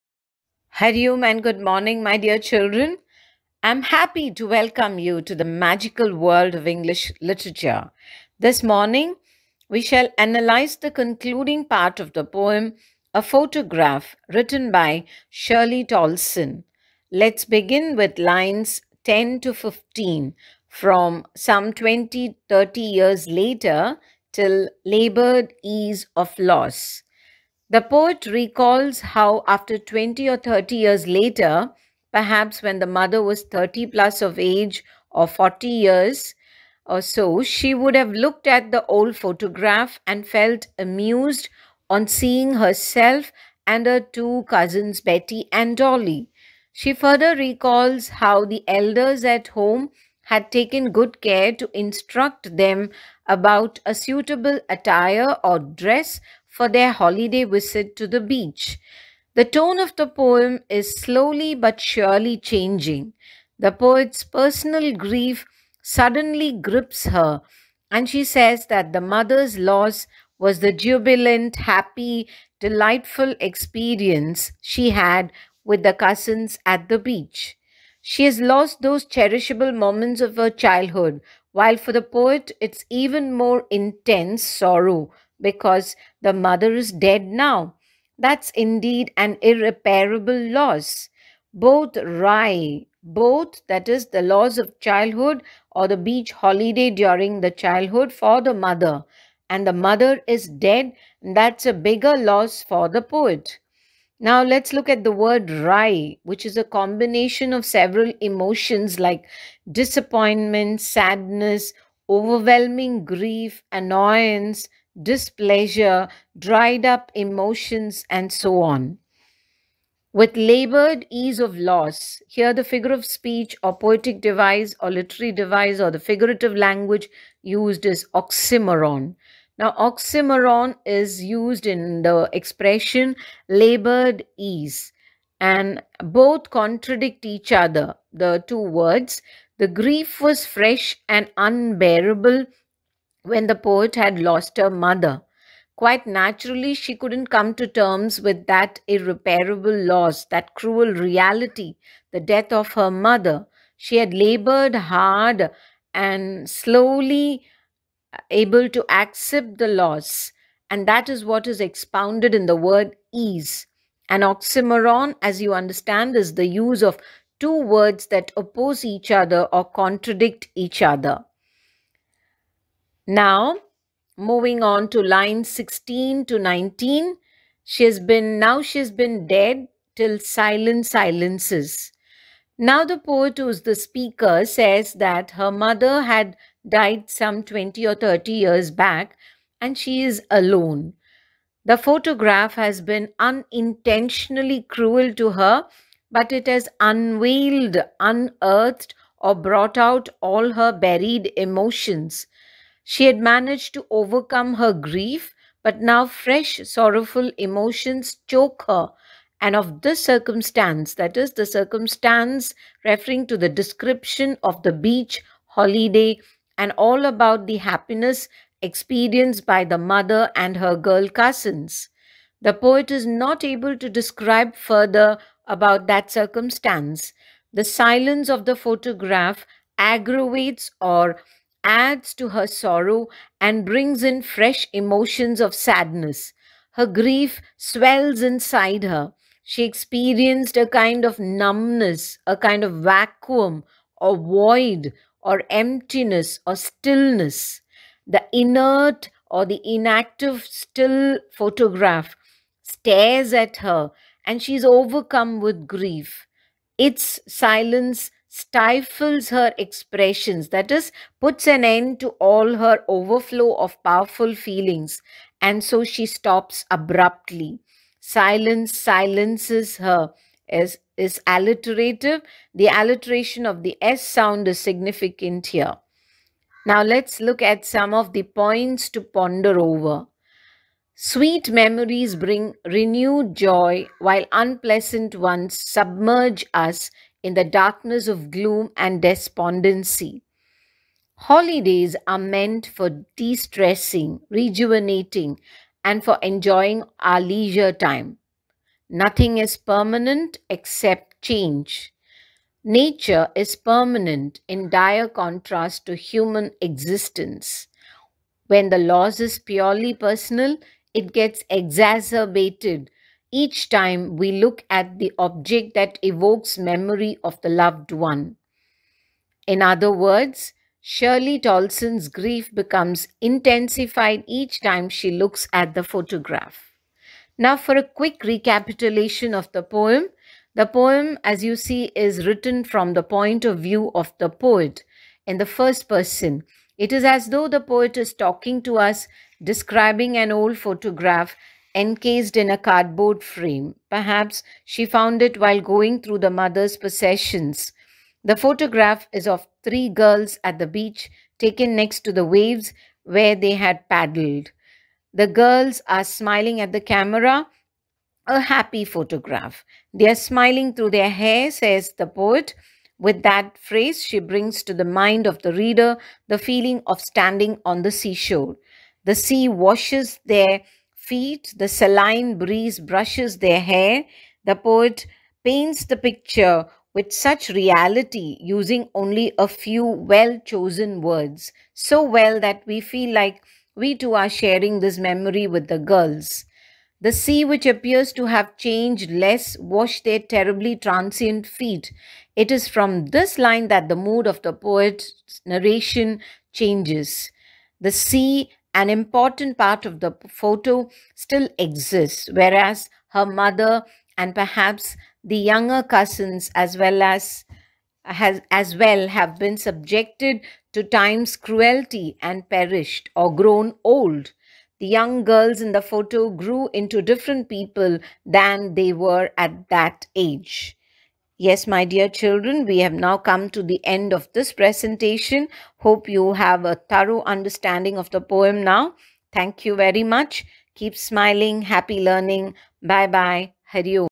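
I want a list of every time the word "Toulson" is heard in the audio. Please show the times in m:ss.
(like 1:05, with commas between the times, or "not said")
0:15, 5:21.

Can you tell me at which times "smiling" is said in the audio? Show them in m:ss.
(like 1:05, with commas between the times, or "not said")
5:56, 6:00, 7:10.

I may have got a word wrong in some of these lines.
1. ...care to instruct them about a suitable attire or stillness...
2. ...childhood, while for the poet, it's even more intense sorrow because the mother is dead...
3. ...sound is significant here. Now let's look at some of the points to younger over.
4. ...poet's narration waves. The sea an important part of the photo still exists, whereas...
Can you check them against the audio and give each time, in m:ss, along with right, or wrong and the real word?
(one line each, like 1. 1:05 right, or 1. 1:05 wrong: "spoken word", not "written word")
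1. 0:51 wrong: "dress", not "stillness"
2. 1:20 right
3. 4:34 wrong: "ponder", not "younger"
4. 6:34 wrong: "changes", not "waves".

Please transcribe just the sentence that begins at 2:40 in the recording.
And that is what is expounded in the word ease.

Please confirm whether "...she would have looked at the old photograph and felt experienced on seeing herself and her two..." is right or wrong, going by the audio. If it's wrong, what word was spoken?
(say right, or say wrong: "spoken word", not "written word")
wrong: "amused", not "experienced".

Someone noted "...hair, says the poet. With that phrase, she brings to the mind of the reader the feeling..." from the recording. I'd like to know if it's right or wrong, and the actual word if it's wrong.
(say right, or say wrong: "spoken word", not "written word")
right.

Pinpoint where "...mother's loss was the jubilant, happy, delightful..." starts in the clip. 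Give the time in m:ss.
1:08.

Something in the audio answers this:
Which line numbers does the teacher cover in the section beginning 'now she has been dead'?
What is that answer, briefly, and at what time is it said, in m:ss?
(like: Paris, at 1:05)
16 to 19, at 2:55.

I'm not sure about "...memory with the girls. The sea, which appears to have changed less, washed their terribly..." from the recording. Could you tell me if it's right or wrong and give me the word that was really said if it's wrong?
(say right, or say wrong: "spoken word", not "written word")
right.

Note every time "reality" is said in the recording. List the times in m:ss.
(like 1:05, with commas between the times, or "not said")
2:30, 6:17.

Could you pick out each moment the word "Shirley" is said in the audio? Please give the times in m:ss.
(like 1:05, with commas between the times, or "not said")
0:15, 5:20.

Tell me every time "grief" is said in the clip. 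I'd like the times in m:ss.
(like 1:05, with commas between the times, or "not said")
1:04, 1:53, 2:19, 3:24, 3:56, 4:15, 5:22.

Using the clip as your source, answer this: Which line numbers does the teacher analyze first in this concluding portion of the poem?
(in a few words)
10 to 15.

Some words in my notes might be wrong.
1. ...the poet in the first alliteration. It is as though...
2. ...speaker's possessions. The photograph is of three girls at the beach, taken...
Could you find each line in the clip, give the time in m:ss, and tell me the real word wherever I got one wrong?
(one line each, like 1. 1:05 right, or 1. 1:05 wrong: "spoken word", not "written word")
1. 5:34 wrong: "person", not "alliteration"
2. 5:46 wrong: "mother", not "speaker".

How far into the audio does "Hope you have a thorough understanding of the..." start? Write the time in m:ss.
7:05.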